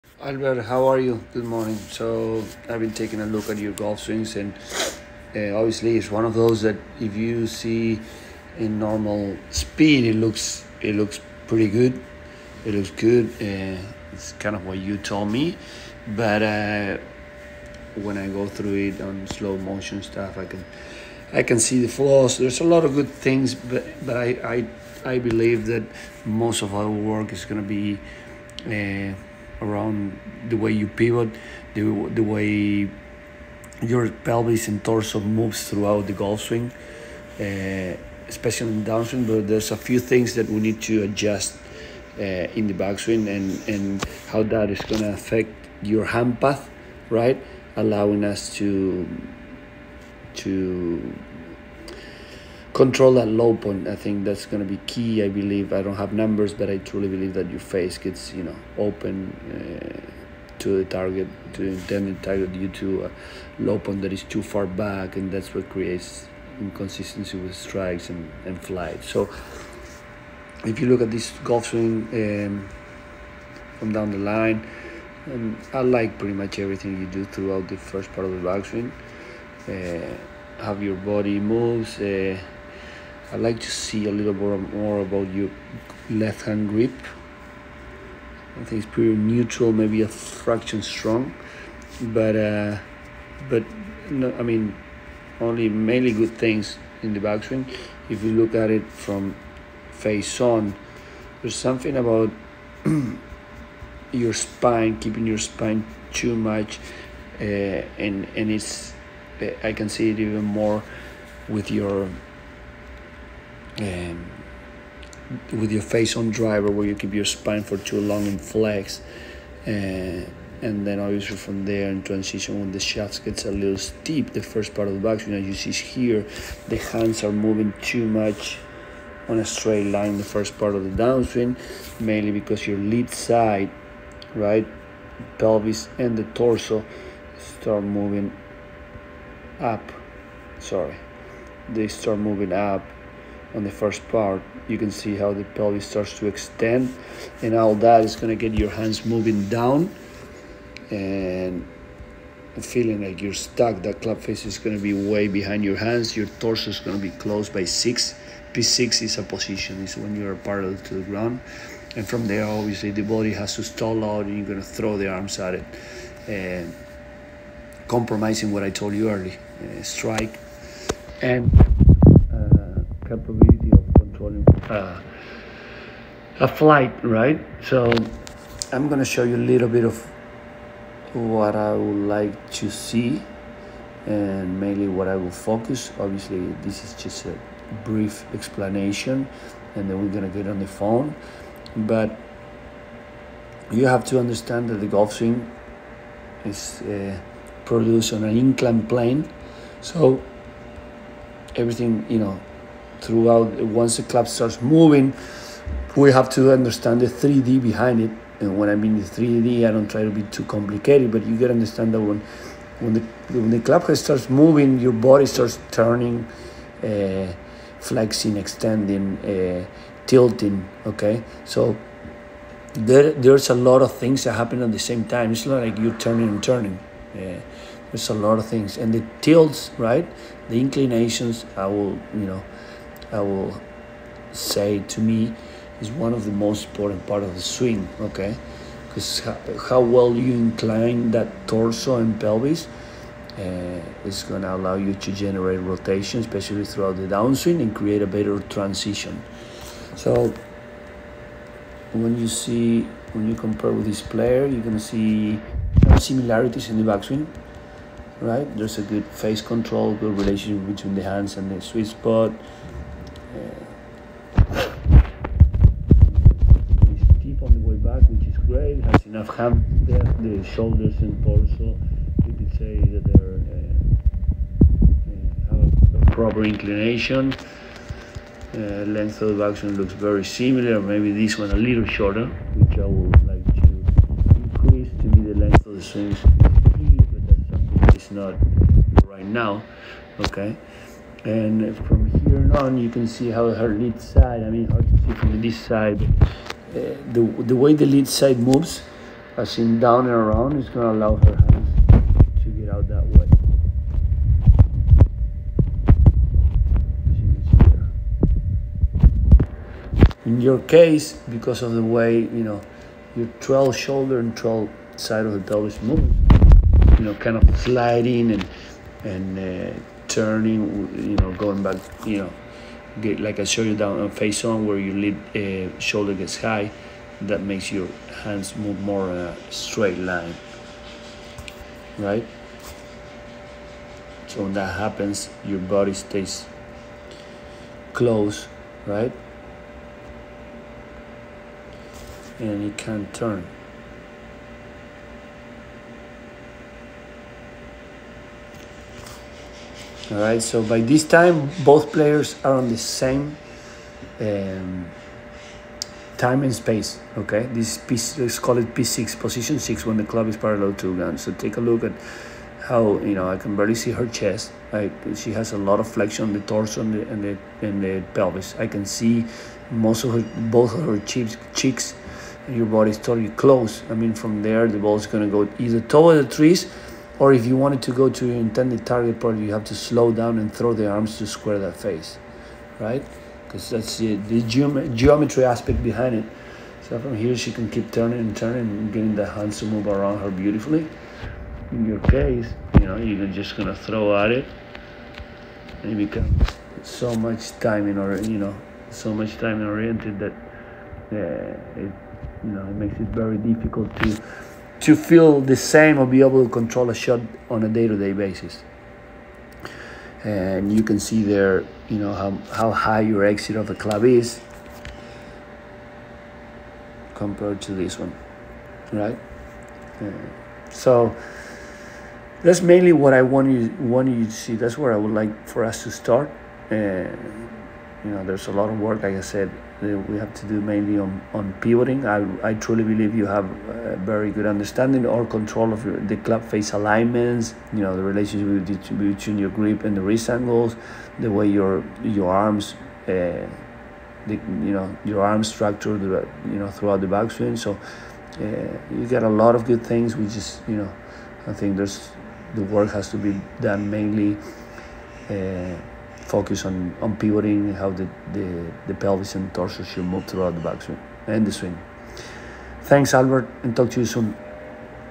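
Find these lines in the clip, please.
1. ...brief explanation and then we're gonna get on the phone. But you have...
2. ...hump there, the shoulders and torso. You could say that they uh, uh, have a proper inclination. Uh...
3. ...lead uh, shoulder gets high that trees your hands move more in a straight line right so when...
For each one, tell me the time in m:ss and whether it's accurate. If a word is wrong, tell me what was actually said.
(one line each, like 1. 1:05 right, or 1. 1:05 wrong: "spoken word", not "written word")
1. 3:07 right
2. 4:29 right
3. 5:24 wrong: "makes", not "trees".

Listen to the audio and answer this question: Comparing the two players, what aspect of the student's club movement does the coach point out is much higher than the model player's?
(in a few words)
Exit of the club.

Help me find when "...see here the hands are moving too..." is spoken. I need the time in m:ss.
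2:05.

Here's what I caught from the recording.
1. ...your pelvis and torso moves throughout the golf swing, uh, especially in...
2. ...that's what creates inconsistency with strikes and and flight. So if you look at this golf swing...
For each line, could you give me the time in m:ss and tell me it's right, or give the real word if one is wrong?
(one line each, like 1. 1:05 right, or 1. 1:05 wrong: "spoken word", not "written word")
1. 0:33 right
2. 1:05 right.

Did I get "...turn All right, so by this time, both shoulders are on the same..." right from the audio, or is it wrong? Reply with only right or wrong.
wrong.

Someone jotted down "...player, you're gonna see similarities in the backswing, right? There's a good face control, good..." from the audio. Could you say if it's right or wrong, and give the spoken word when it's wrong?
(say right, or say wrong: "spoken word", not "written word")
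right.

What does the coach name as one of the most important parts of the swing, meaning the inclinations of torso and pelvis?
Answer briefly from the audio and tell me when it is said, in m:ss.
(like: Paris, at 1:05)
The tilts, at 3:48.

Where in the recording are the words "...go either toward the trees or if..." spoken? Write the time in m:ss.
6:15.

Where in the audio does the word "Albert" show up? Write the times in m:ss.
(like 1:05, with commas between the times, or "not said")
0:00, 7:43.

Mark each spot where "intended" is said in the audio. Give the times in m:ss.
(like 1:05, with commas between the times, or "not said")
1:01, 6:18.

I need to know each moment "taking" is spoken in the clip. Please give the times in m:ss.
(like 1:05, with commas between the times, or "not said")
0:02.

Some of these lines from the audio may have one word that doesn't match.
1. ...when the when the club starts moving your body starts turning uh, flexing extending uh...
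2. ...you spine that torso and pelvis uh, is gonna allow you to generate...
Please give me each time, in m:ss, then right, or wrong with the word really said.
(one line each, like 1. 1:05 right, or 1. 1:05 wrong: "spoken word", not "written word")
1. 3:32 right
2. 4:00 wrong: "incline", not "spine".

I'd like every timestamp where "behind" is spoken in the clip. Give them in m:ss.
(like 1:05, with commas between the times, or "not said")
2:35, 3:27, 6:25.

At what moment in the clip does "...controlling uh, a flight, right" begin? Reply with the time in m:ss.
2:53.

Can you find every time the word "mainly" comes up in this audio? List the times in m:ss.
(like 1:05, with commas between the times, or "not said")
1:35, 2:12, 3:04, 7:02, 7:10, 7:33.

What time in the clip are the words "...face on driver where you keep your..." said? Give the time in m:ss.
1:55.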